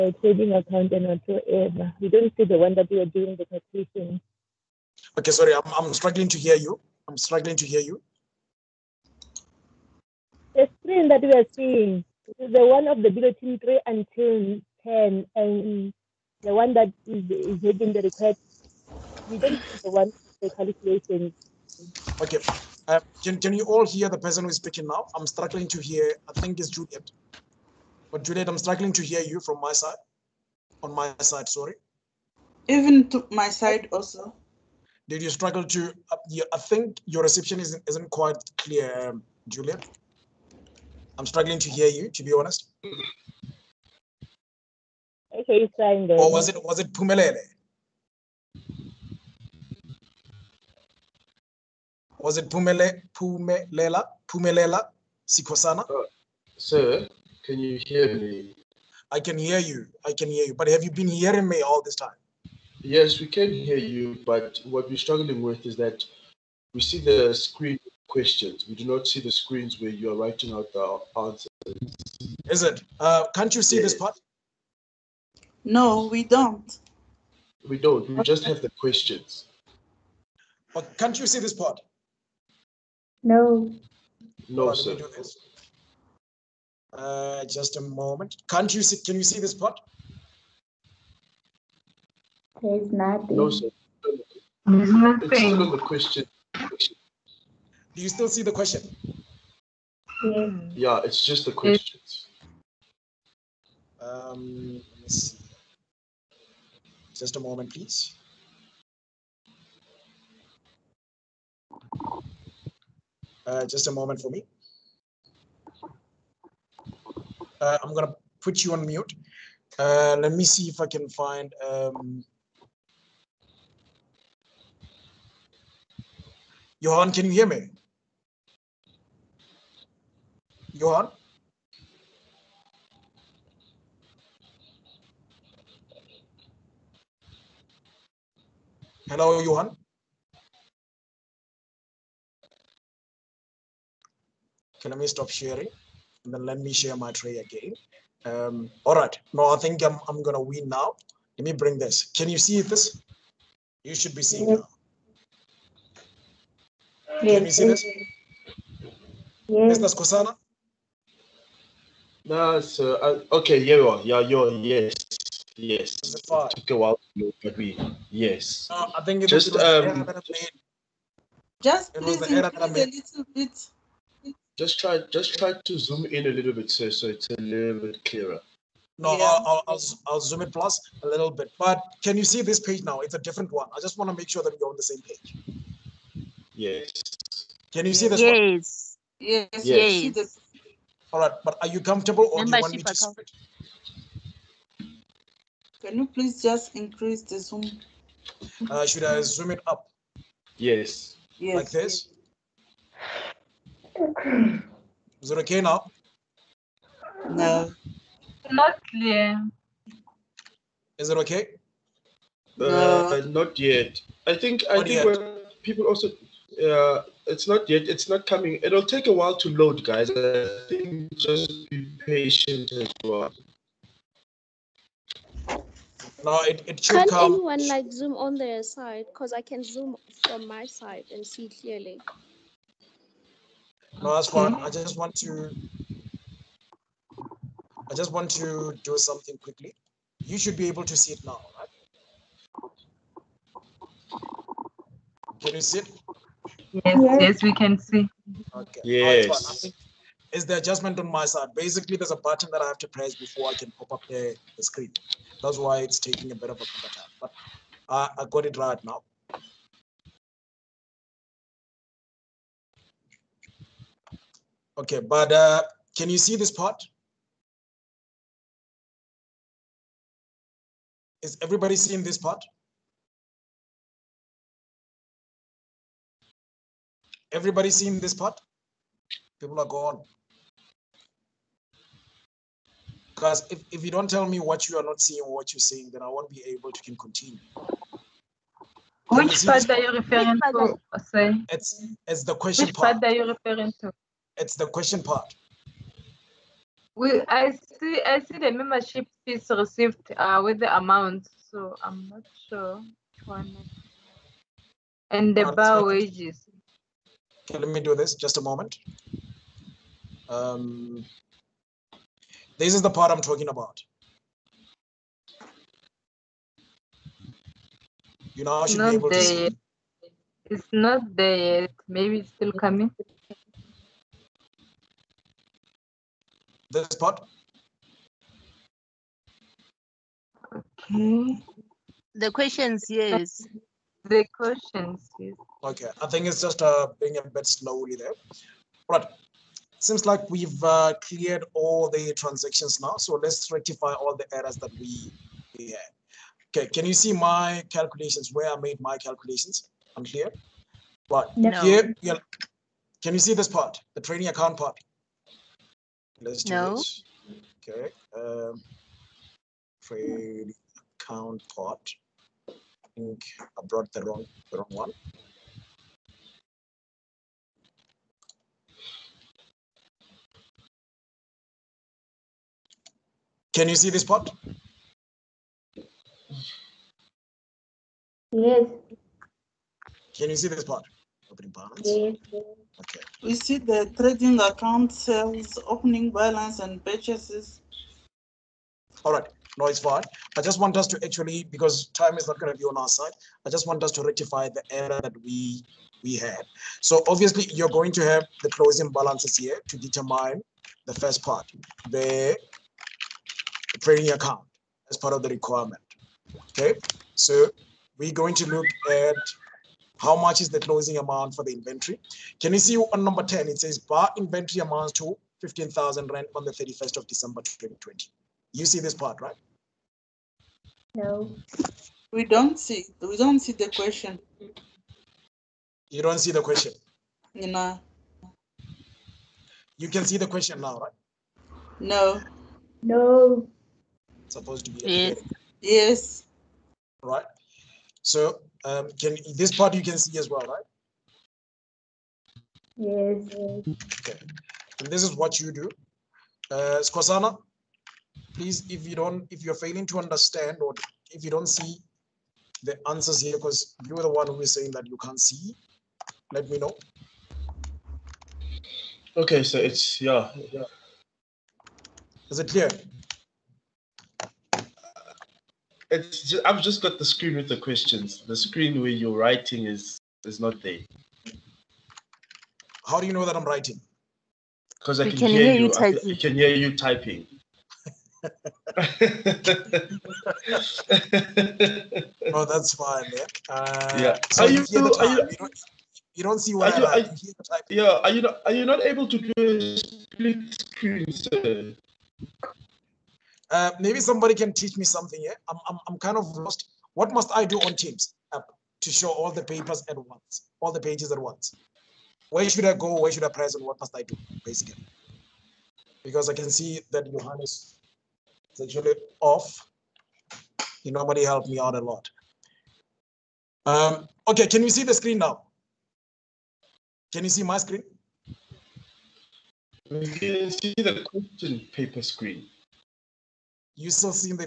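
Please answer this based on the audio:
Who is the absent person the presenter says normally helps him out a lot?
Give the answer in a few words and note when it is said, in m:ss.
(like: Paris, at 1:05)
Johannes, at 8:27.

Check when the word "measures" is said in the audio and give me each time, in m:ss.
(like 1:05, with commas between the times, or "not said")
not said.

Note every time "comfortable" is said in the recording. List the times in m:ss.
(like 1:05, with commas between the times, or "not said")
3:11.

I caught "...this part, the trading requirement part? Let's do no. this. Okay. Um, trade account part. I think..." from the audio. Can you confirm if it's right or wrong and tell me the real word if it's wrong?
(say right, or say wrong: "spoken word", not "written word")
wrong: "account", not "requirement".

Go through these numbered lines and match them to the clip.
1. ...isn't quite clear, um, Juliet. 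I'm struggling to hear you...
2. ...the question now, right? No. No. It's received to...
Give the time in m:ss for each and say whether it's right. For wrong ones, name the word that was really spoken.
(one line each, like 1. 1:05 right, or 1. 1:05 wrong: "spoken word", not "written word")
1. 0:37 right
2. 7:10 wrong: "supposed", not "received".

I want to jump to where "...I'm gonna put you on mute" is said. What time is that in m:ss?
1:57.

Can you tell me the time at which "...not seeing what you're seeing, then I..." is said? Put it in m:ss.
4:44.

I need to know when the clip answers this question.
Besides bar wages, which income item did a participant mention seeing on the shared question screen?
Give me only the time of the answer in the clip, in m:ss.
4:58.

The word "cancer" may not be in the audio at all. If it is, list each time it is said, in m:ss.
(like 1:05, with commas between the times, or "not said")
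not said.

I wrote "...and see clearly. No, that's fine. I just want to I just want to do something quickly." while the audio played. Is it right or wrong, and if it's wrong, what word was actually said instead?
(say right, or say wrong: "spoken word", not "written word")
right.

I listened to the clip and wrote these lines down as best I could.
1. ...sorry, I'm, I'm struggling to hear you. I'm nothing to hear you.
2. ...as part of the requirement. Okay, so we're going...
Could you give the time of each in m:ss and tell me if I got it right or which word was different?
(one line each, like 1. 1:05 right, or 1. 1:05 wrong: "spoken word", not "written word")
1. 0:05 wrong: "struggling", not "nothing"
2. 6:44 right.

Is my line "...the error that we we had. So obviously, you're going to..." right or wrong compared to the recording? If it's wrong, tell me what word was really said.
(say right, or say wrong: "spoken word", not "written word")
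right.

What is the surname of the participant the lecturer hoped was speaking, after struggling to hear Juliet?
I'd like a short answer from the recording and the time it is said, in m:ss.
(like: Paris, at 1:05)
Sikosana, at 0:54.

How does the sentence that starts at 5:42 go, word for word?
So let's rectify all the errors that we, we had.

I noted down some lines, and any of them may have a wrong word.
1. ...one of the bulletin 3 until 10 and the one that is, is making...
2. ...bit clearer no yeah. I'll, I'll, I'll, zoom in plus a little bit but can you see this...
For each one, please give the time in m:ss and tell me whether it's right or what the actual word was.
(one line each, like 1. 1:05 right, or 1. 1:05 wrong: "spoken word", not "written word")
1. 0:12 right
2. 2:57 right.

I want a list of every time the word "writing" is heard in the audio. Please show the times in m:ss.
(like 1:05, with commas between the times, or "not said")
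1:10, 7:49, 7:53.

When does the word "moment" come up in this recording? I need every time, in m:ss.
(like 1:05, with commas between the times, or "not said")
1:27, 1:47, 1:53, 5:08.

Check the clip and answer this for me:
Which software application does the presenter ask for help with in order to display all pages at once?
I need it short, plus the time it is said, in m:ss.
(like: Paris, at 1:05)
Teams, at 8:17.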